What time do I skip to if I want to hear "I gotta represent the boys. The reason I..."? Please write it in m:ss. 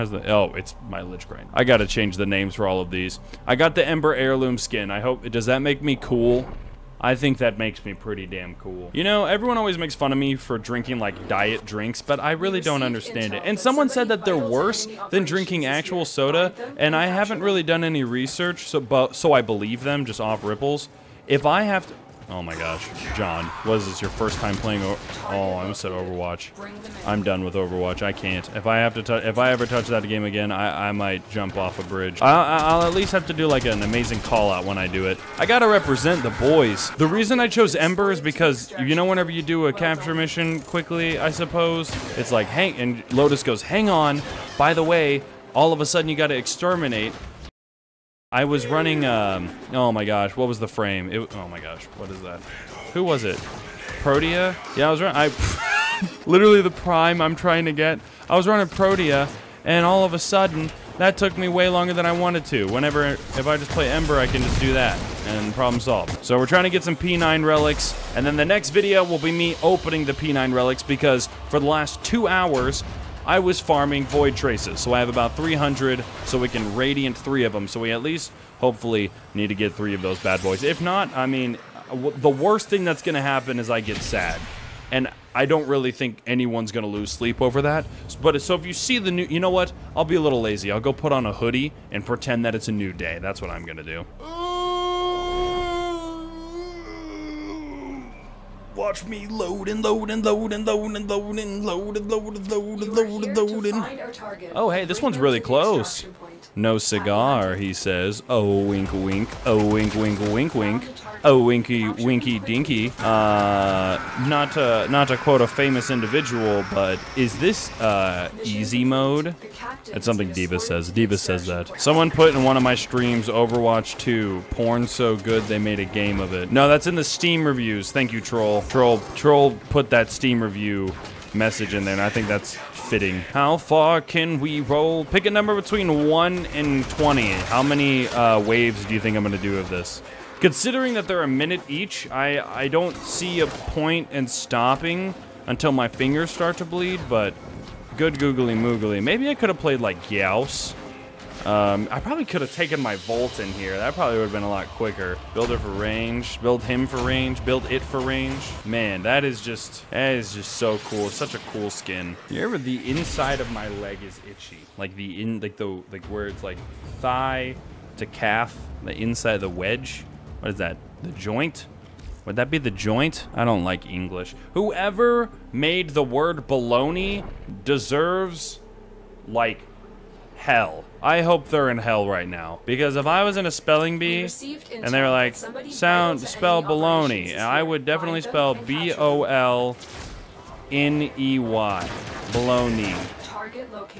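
0:35.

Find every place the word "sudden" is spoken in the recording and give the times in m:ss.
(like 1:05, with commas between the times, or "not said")
0:45, 1:00.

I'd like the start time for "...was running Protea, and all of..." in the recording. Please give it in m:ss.
0:58.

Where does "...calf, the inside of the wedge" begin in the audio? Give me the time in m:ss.
2:48.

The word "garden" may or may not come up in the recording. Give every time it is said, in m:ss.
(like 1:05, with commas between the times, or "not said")
not said.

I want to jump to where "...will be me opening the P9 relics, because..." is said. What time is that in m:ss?
1:09.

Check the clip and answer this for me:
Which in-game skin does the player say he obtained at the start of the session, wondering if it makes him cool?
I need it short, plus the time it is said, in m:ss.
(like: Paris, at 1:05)
Ember Heirloom, at 0:03.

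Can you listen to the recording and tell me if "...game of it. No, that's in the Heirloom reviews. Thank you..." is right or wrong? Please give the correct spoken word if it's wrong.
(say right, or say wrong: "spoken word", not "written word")
wrong: "Steam", not "Heirloom".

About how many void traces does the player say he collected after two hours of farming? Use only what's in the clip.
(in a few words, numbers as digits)
300.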